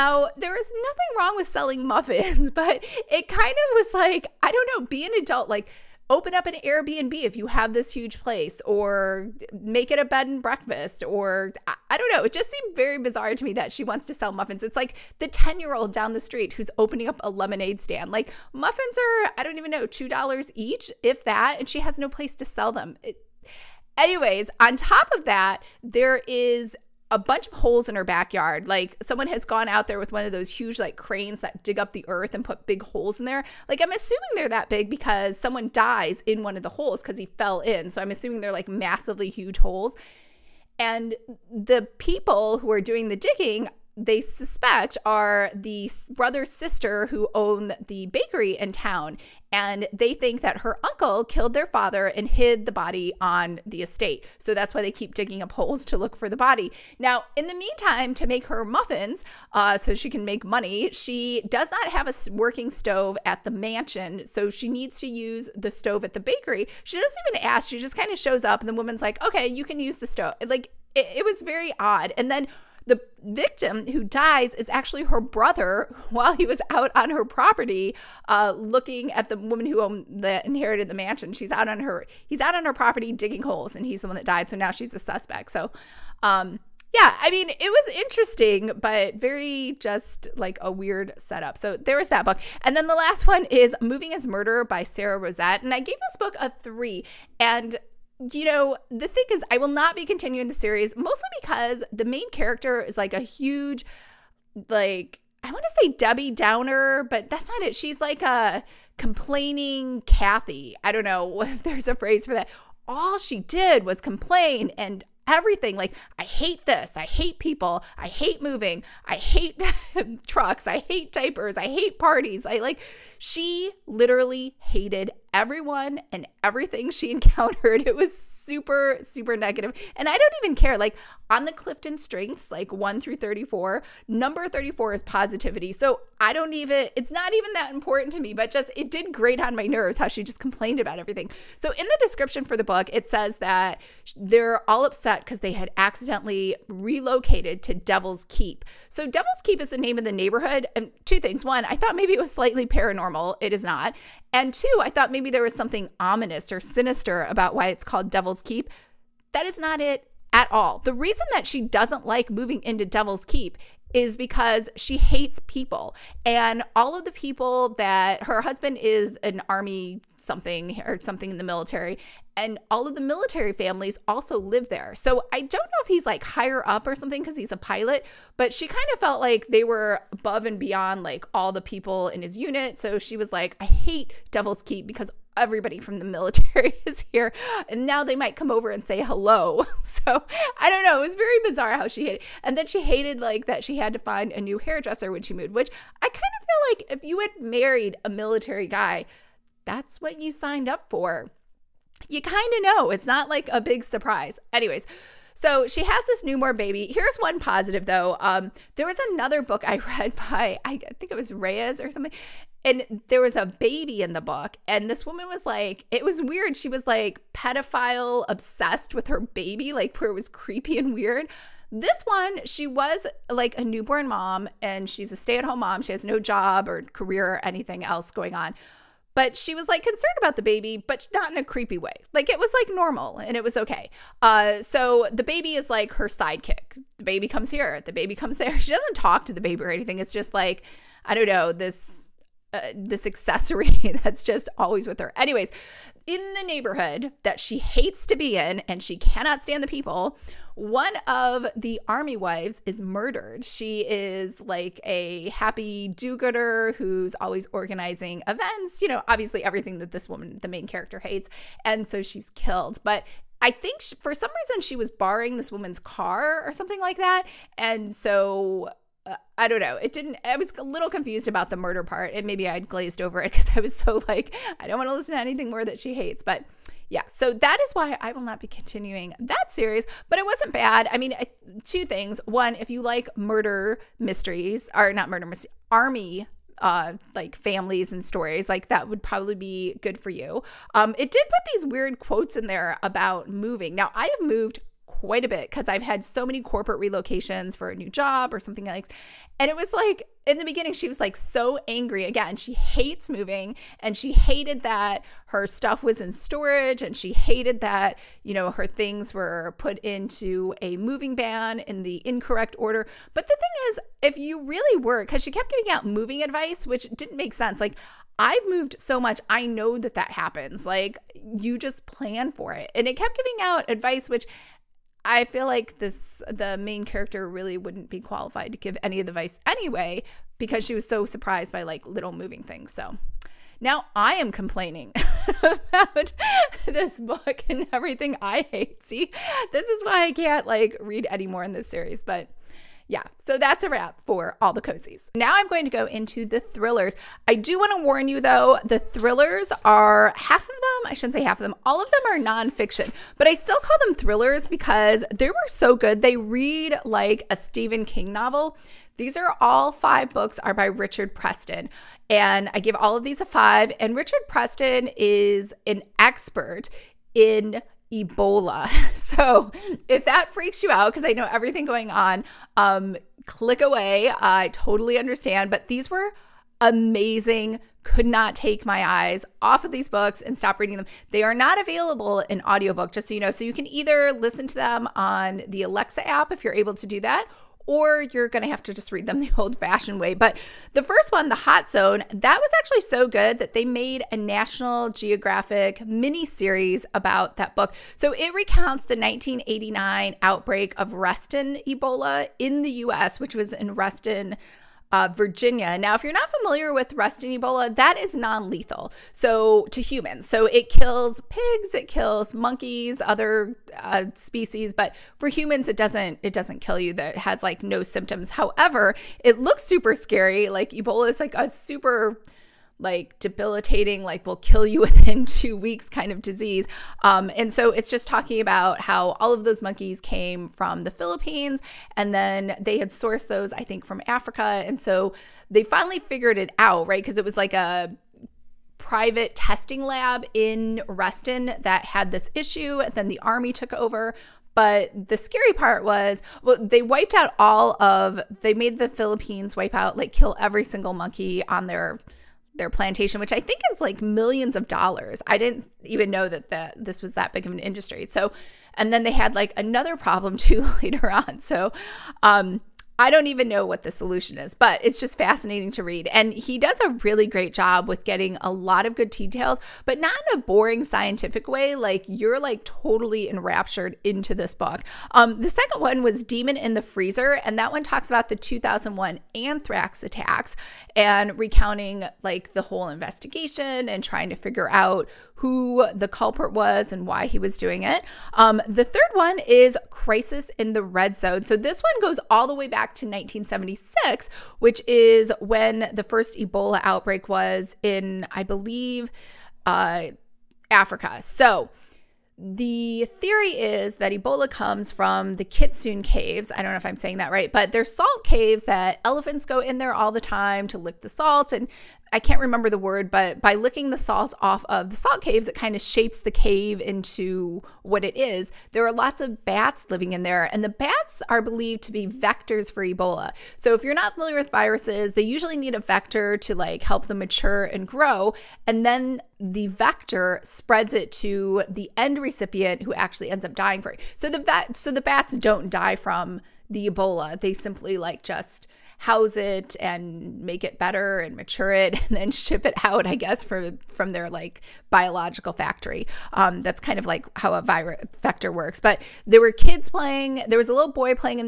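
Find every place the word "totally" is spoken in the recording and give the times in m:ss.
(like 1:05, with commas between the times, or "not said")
6:14, 7:52.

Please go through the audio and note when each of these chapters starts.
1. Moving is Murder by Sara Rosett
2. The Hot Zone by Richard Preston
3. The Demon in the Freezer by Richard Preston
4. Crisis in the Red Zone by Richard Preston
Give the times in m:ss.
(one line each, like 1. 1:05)
1. 1:34
2. 6:30
3. 7:55
4. 8:09.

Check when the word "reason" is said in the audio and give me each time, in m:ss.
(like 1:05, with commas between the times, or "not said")
2:40, 4:24.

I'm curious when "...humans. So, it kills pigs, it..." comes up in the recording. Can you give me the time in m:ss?
6:49.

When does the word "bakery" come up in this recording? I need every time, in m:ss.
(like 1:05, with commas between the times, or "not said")
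0:48, 1:06.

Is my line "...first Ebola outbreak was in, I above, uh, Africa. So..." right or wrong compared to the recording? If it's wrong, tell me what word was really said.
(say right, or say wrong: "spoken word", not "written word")
wrong: "believe", not "above".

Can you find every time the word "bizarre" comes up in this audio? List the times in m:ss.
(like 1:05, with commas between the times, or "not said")
0:12, 3:11.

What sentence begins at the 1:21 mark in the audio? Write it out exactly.
She's out on her he's out on her property digging holes and he's the one that died.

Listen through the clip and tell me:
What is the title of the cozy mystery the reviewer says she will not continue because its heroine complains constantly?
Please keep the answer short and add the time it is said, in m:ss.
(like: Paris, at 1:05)
Moving as Murder, at 1:33.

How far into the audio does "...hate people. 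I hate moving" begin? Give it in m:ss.
1:57.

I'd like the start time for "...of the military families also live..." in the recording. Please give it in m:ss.
2:52.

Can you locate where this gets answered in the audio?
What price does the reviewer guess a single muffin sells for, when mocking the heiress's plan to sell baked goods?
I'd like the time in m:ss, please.
0:19.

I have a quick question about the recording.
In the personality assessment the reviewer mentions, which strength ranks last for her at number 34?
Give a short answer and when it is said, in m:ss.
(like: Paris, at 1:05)
Positivity, at 2:15.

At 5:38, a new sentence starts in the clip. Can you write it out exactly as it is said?
See, this is why I can't like read anymore in this series, but yeah, so that's a wrap for all the cozies.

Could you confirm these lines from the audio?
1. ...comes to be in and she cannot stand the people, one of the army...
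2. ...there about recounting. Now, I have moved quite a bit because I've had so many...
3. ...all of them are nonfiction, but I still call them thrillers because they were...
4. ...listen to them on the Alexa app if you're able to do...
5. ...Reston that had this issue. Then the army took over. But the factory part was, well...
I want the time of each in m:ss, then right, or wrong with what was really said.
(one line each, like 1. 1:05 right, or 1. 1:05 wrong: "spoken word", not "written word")
1. 4:07 wrong: "hates", not "comes"
2. 4:52 wrong: "moving", not "recounting"
3. 5:51 right
4. 6:24 right
5. 7:20 wrong: "scary", not "factory".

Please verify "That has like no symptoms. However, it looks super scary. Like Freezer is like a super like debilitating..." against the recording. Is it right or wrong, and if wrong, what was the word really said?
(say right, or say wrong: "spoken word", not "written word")
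wrong: "Ebola", not "Freezer".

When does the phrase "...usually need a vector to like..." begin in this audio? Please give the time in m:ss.
8:45.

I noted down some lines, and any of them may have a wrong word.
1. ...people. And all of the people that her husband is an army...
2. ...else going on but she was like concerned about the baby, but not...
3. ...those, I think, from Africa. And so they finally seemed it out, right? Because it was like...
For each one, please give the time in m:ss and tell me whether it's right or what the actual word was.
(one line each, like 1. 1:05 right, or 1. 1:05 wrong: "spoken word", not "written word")
1. 2:45 right
2. 3:47 right
3. 7:13 wrong: "figured", not "seemed".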